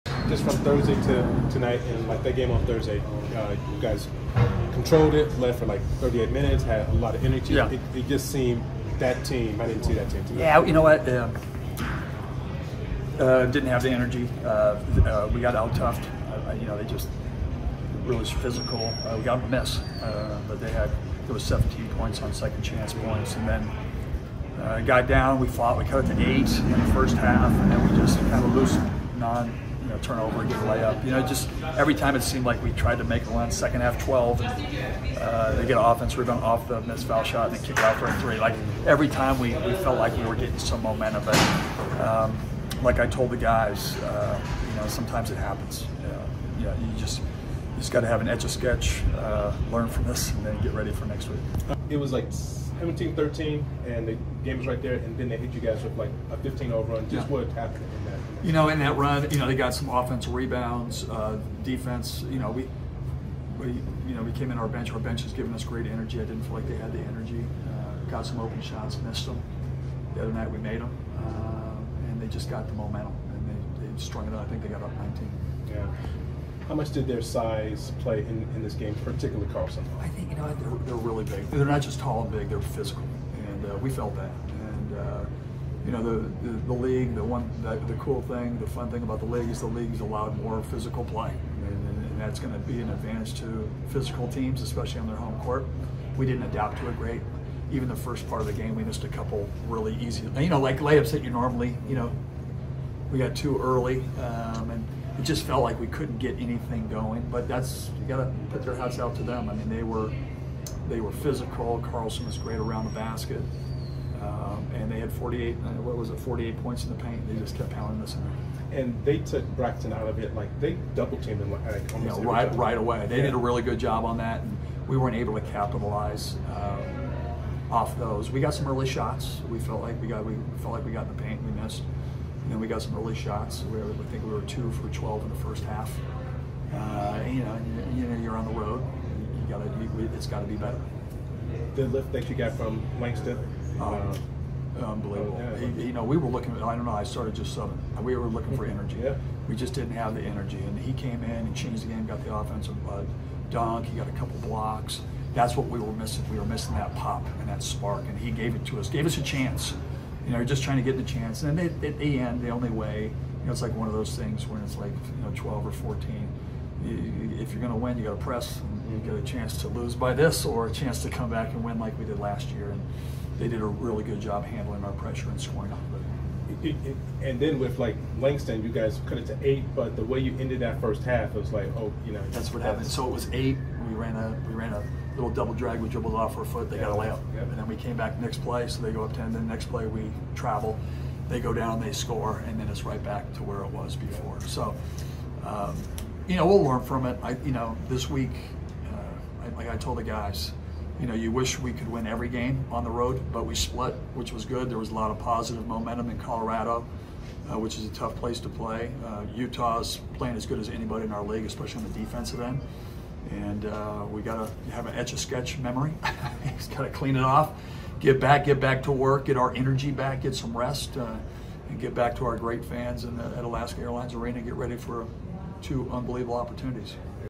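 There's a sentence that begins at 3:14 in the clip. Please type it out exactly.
So, um, you know, we'll learn from it.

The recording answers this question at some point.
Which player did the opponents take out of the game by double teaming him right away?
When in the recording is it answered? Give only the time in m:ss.
1:59.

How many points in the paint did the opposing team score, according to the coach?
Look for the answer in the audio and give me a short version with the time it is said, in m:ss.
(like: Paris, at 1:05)
48, at 1:56.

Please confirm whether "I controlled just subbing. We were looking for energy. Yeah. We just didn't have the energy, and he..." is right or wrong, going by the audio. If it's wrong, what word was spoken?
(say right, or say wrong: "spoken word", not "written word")
wrong: "started", not "controlled".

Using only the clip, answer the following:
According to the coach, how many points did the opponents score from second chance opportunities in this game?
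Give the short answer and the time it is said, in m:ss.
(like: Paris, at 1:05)
17, at 0:21.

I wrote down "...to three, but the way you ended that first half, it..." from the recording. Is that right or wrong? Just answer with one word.
wrong.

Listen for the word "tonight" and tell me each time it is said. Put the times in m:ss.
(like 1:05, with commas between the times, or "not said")
0:01, 0:10.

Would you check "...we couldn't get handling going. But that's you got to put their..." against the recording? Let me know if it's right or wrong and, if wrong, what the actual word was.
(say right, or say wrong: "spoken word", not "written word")
wrong: "anything", not "handling".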